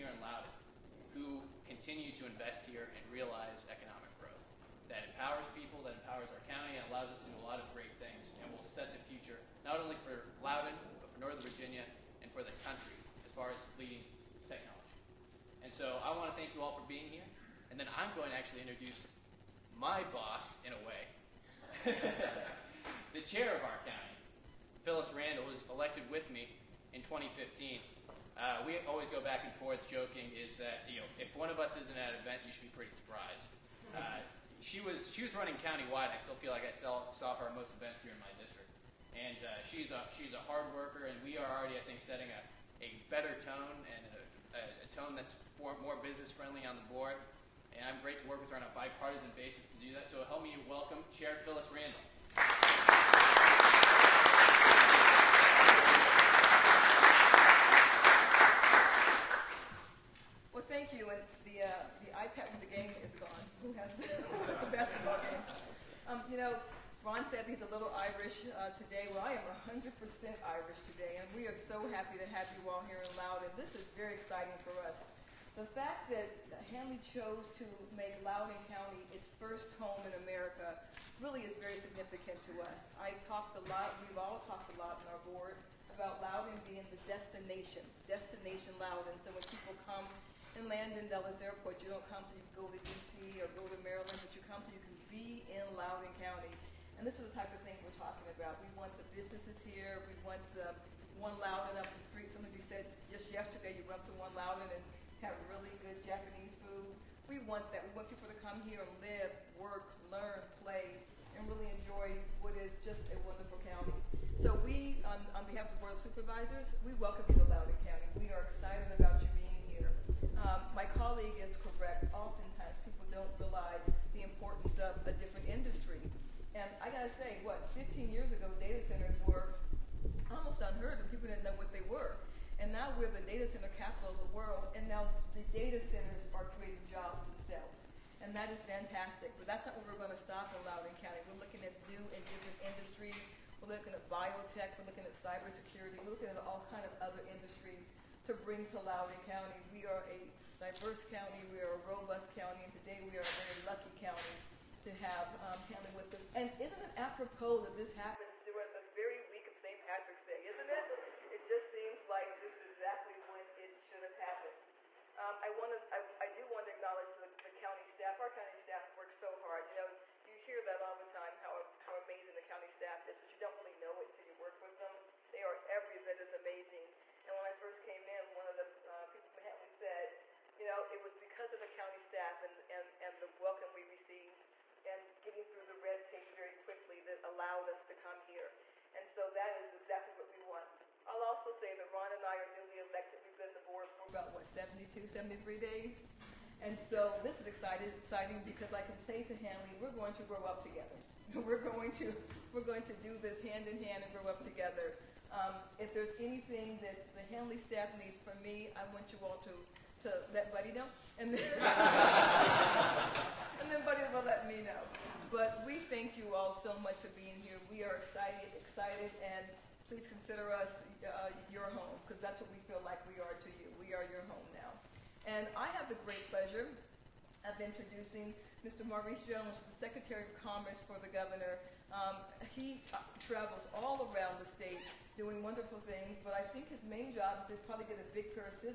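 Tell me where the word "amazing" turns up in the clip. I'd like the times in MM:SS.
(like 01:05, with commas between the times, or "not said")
02:52, 02:56.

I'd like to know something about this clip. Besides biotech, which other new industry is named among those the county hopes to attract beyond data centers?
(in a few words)
Cybersecurity.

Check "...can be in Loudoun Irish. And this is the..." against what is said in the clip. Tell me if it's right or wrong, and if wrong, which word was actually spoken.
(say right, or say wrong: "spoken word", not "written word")
wrong: "County", not "Irish".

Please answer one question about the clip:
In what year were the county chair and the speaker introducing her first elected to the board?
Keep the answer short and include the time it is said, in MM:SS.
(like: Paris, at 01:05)
2015, at 00:27.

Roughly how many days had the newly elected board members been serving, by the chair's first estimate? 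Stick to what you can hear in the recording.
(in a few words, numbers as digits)
72.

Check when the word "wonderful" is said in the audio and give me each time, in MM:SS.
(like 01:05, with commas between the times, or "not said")
01:53, 03:55.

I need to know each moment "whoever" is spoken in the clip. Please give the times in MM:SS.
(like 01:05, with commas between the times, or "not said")
not said.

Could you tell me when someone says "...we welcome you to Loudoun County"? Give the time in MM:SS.
01:56.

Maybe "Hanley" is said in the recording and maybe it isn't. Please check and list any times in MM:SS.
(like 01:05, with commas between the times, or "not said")
01:16, 02:59, 03:19, 03:27.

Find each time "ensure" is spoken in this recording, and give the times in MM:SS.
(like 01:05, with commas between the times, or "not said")
not said.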